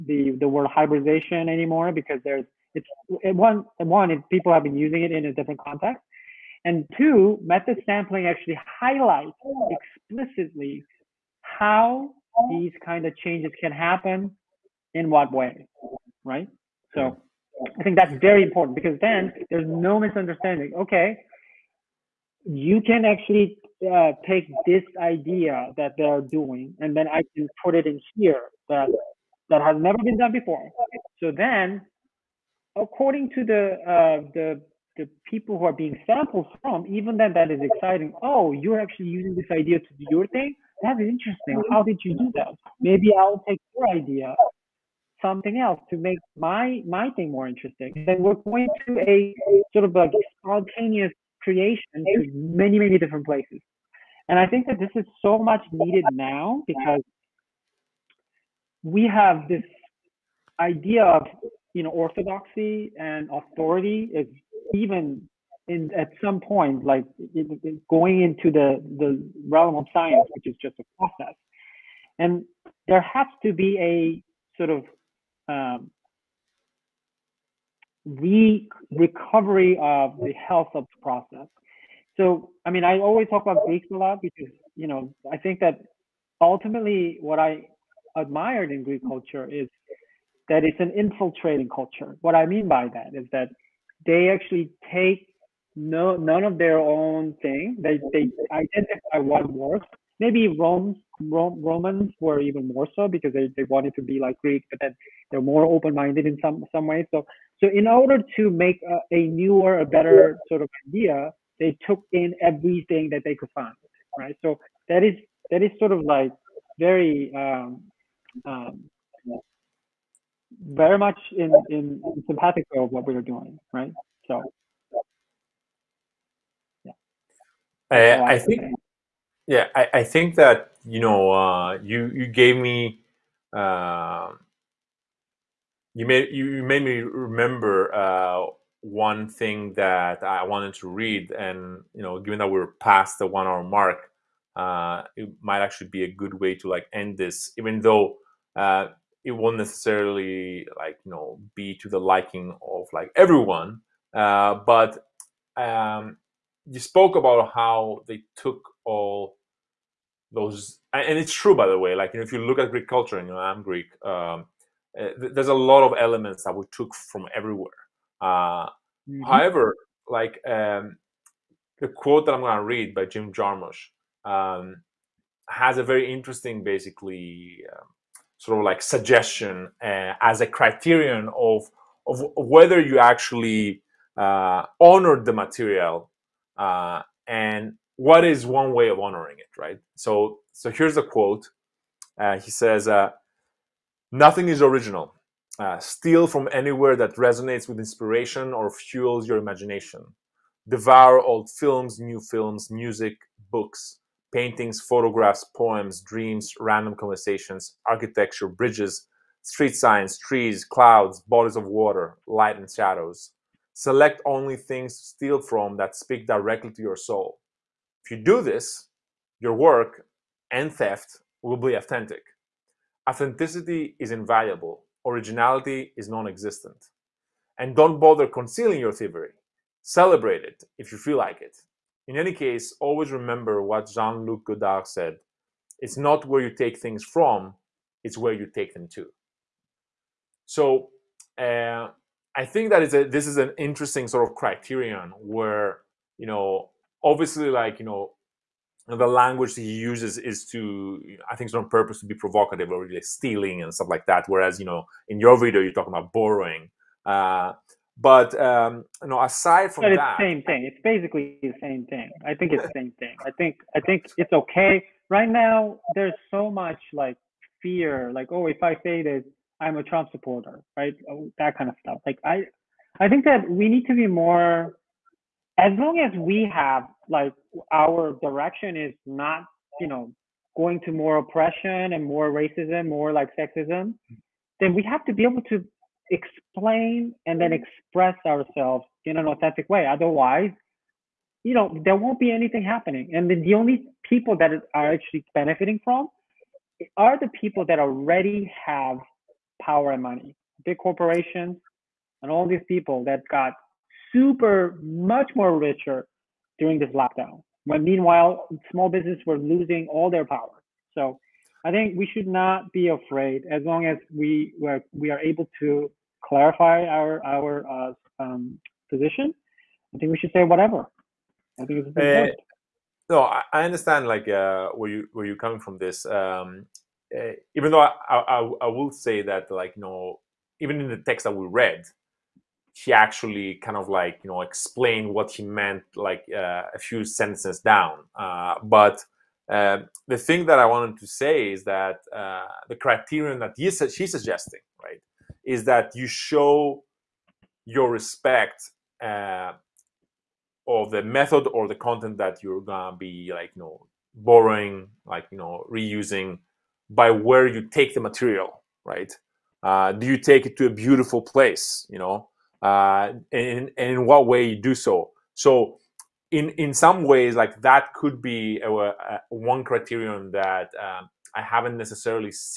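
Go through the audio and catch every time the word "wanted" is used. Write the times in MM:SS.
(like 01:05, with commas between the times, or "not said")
01:43, 02:20, 05:40.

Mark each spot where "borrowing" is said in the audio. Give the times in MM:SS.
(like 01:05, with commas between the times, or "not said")
04:16, 05:54.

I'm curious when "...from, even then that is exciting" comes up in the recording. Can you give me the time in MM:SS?
00:36.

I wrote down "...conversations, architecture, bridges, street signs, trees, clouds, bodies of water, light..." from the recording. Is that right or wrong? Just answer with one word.
right.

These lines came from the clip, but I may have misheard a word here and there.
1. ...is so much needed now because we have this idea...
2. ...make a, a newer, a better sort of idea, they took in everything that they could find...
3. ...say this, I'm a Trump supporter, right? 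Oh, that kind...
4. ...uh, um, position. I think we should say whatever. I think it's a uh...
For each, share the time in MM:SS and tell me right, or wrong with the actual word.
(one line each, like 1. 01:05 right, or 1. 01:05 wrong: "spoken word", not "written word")
1. 00:54 right
2. 01:48 right
3. 04:28 right
4. 05:17 right.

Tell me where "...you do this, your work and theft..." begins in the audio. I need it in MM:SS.
03:38.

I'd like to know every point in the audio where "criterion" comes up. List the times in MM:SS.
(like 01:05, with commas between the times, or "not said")
03:00, 04:04, 05:42, 06:09.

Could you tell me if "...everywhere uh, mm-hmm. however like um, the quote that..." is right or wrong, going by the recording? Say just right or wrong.
right.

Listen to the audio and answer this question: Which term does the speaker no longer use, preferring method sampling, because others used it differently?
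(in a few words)
hybridization.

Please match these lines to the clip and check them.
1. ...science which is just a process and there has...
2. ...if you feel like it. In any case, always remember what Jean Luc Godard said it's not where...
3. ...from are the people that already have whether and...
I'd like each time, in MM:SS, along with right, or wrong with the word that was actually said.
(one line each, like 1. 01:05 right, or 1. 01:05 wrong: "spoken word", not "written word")
1. 01:09 right
2. 03:50 right
3. 04:55 wrong: "power", not "whether".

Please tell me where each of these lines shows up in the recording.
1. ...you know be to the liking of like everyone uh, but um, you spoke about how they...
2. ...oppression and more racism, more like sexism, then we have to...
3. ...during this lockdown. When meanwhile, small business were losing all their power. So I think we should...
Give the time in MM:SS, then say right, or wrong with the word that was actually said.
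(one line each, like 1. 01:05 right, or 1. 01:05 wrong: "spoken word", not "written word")
1. 02:31 right
2. 04:41 right
3. 05:06 right.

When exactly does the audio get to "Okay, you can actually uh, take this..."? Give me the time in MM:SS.
00:20.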